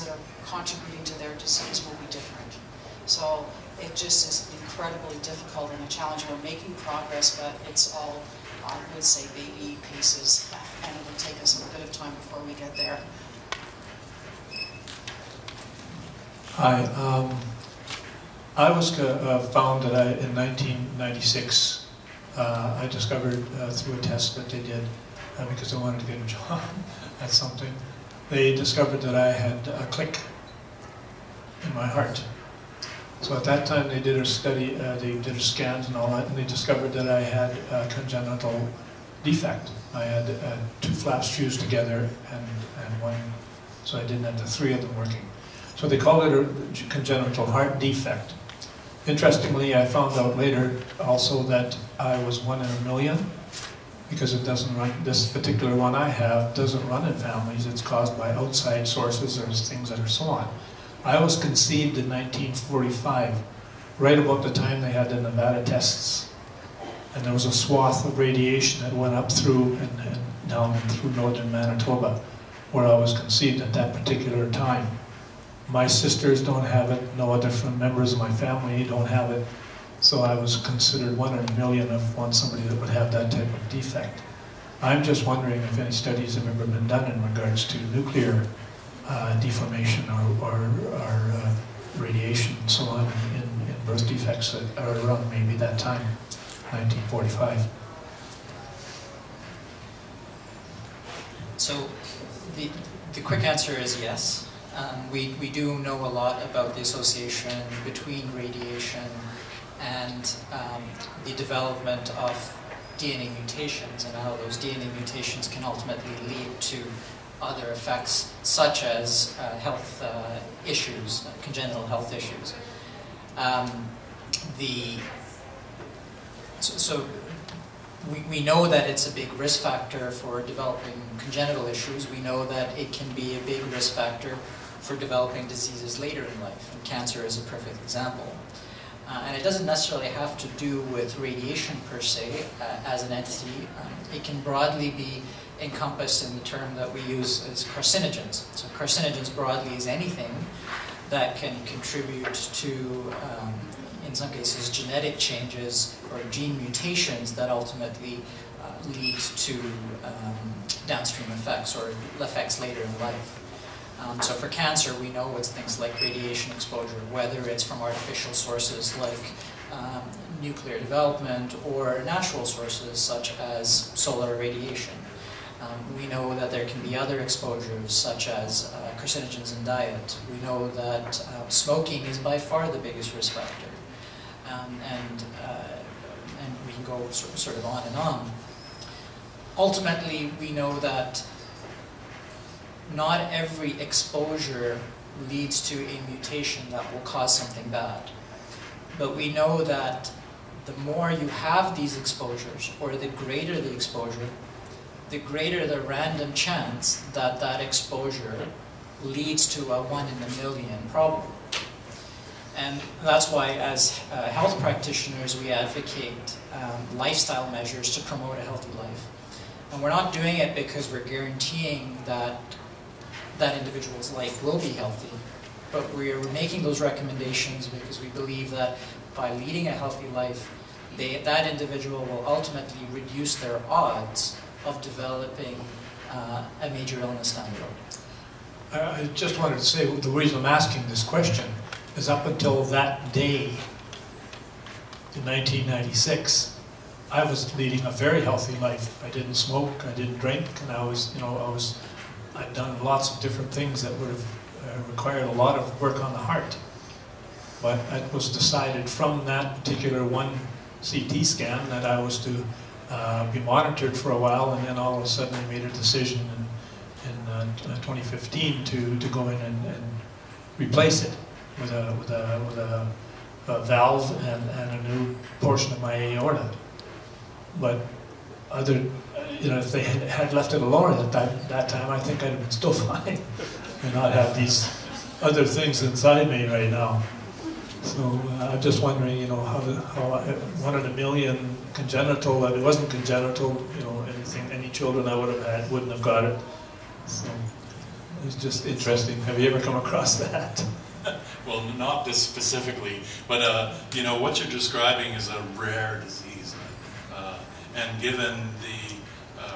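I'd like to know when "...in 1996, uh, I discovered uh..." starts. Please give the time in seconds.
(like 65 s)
20 s.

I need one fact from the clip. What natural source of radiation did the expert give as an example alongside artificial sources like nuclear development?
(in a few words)
Solar radiation.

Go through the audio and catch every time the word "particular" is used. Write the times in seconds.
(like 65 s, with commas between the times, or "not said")
55 s, 73 s, 259 s.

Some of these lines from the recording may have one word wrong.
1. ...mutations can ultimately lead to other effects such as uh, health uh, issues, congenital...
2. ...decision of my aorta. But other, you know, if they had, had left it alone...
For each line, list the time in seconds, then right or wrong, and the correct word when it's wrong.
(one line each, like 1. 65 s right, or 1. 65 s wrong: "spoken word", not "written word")
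1. 114 s right
2. 275 s wrong: "portion", not "decision".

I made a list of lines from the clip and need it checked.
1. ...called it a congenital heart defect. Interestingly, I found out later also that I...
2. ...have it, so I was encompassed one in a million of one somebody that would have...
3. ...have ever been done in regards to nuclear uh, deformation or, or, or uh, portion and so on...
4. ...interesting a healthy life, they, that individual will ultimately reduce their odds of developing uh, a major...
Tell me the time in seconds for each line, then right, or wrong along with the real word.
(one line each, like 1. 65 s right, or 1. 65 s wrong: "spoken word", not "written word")
1. 45 s right
2. 79 s wrong: "considered", not "encompassed"
3. 86 s wrong: "radiation", not "portion"
4. 229 s wrong: "leading", not "interesting".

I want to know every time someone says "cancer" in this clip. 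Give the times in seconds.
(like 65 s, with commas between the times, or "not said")
136 s, 164 s.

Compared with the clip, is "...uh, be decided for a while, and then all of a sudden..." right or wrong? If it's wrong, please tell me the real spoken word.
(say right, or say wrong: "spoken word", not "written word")
wrong: "monitored", not "decided".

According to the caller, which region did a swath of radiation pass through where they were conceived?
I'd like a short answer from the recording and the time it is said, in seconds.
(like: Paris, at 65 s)
Northern Manitoba, at 71 s.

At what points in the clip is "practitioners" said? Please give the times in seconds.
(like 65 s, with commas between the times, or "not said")
214 s.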